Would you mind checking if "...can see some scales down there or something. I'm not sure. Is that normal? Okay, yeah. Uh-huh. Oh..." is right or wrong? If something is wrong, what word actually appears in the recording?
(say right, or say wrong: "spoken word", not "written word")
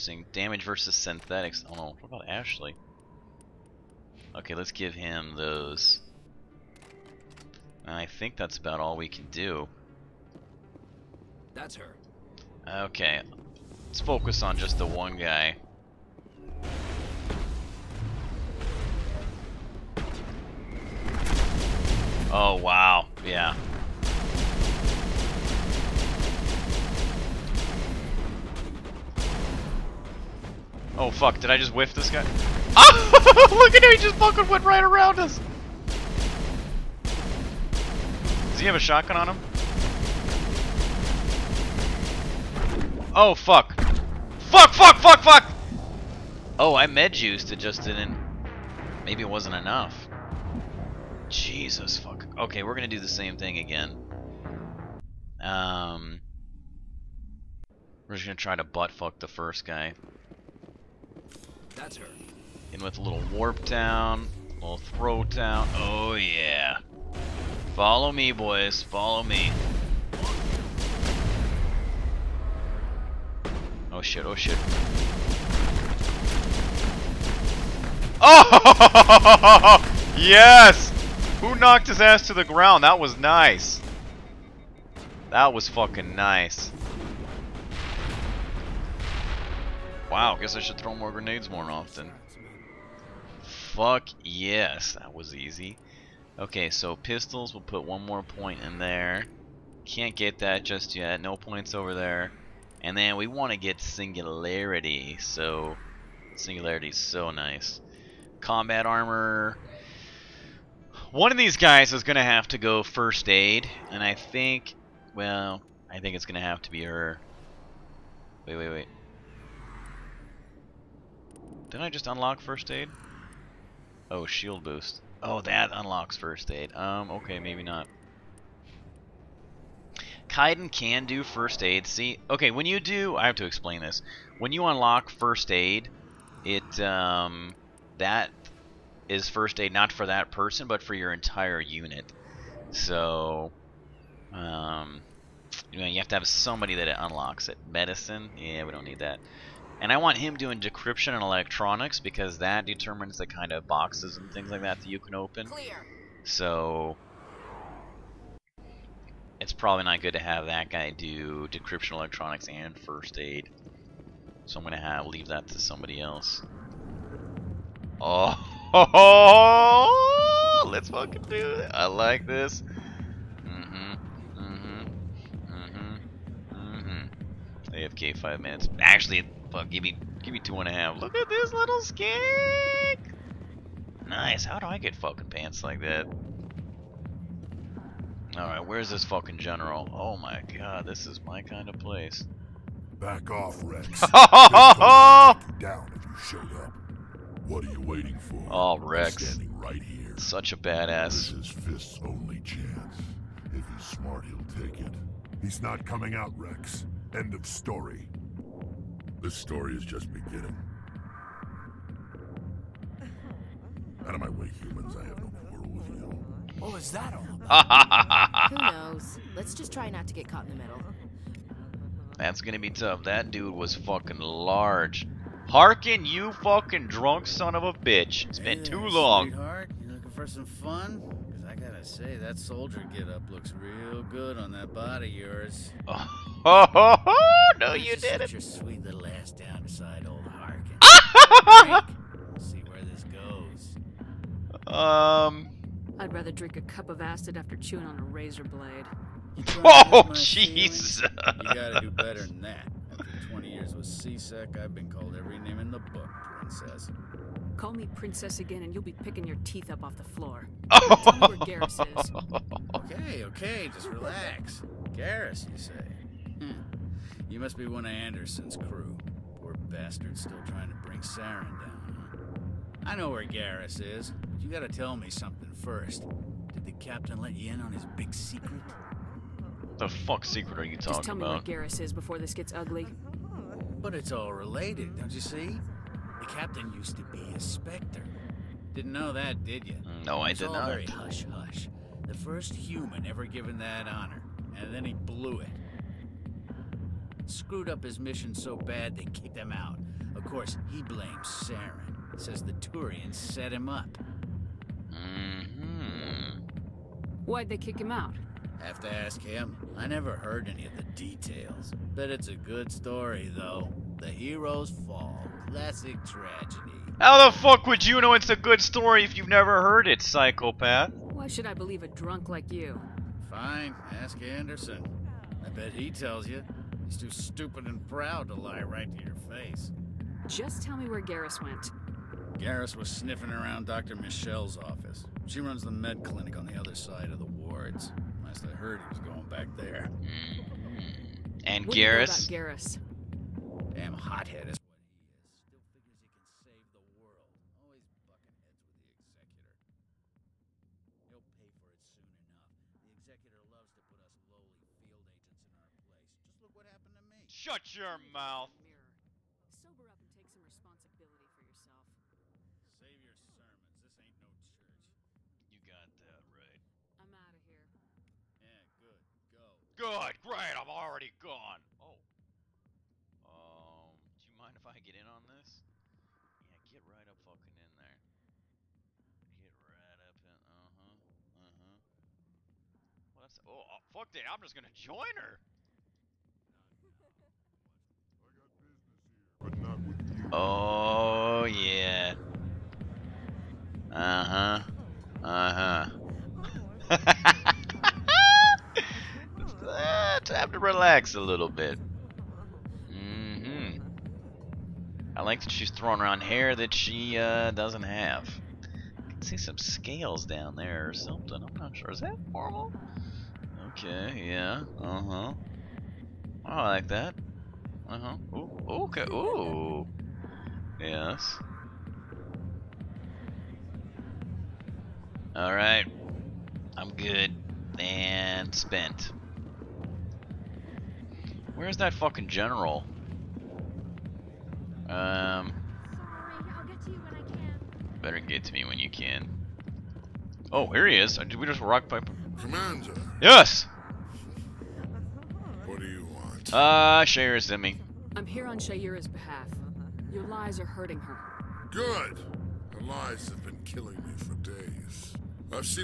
right.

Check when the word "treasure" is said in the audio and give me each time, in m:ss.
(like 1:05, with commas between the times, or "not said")
not said.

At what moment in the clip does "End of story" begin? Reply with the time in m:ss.
3:27.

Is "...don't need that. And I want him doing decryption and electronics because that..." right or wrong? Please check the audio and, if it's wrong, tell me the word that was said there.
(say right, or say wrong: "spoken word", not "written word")
right.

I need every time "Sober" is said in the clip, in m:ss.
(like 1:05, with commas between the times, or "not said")
5:59.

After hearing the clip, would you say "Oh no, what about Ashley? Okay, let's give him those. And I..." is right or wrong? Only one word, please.
right.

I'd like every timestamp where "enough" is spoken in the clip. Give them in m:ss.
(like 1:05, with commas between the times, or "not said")
0:49, 5:52.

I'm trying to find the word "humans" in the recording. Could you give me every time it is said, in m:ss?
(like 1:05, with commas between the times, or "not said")
3:34, 4:52.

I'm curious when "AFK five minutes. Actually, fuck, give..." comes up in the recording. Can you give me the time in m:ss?
2:57.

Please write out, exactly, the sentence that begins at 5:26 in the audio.
He's too stupid and proud to lie right to your face.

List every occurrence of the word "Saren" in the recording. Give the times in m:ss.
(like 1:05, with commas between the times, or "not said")
4:31, 5:01.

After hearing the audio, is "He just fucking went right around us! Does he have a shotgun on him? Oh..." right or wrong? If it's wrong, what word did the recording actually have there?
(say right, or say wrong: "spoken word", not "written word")
right.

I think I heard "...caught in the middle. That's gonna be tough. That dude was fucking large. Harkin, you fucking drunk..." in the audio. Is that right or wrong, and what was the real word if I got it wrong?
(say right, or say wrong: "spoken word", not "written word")
right.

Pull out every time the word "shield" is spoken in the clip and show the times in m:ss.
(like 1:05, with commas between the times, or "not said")
2:04.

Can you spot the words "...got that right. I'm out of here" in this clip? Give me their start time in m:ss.
6:05.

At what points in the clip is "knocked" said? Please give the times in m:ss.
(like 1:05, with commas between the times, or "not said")
1:21.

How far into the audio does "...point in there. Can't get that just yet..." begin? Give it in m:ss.
1:38.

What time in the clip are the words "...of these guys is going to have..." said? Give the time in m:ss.
1:51.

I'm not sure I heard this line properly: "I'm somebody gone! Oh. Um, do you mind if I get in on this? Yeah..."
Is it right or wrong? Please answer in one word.
wrong.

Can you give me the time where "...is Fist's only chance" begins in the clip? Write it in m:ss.
3:21.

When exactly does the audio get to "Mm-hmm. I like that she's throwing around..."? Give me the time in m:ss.
6:42.